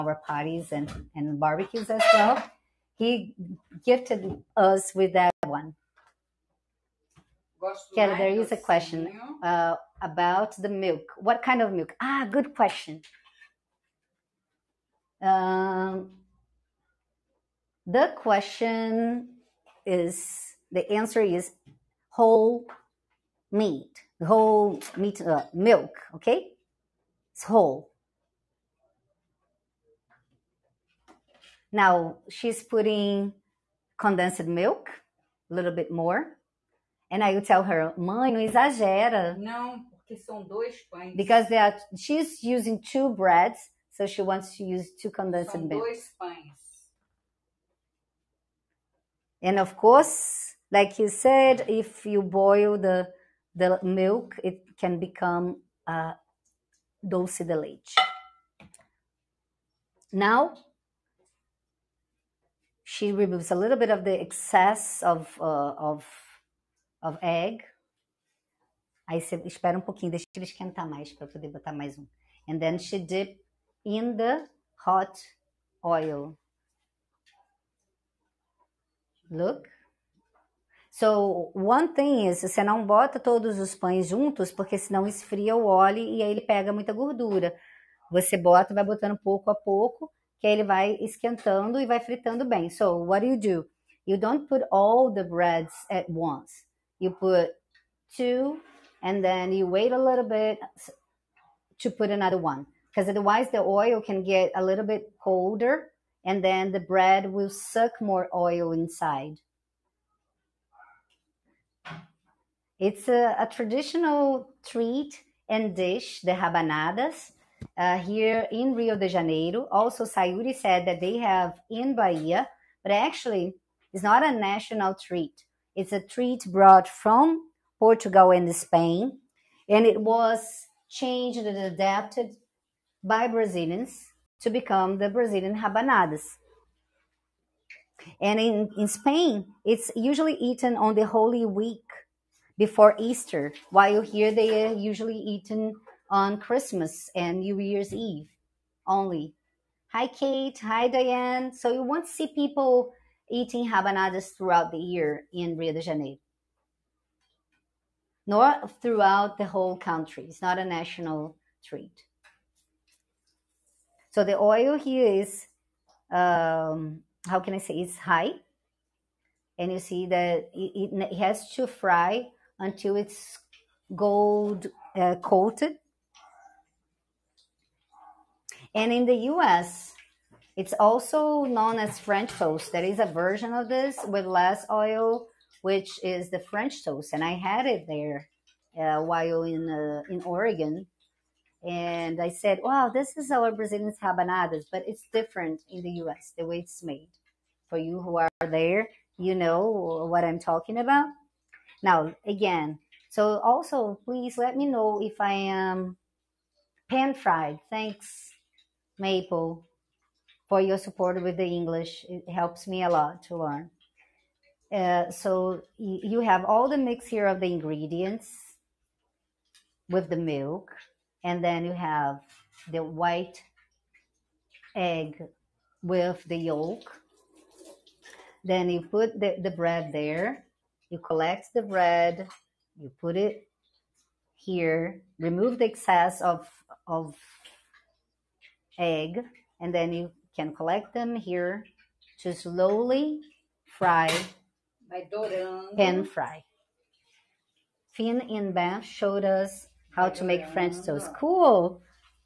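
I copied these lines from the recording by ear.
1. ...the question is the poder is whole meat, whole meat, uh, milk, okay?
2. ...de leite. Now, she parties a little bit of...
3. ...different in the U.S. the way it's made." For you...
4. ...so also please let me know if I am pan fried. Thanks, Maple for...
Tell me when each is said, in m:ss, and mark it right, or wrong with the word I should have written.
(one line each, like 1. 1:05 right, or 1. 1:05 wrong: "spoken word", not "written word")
1. 0:17 wrong: "answer", not "poder"
2. 0:57 wrong: "removes", not "parties"
3. 3:15 right
4. 3:23 right.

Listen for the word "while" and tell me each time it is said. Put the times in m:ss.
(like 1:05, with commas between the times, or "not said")
2:23, 3:09.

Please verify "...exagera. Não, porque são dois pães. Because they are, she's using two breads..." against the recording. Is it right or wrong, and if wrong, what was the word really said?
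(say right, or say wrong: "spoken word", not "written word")
right.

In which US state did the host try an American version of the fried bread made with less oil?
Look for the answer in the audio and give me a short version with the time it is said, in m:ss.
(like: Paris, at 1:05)
Oregon, at 3:10.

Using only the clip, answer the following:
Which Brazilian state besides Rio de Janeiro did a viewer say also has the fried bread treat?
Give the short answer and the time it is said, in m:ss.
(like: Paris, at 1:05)
Bahia, at 2:01.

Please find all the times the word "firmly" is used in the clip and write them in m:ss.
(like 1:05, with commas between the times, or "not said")
not said.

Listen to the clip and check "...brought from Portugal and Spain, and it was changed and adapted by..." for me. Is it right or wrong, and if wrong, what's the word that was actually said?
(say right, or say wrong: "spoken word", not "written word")
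right.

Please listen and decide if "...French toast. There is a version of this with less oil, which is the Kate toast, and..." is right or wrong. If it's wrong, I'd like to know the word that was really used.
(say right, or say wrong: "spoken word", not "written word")
wrong: "French", not "Kate".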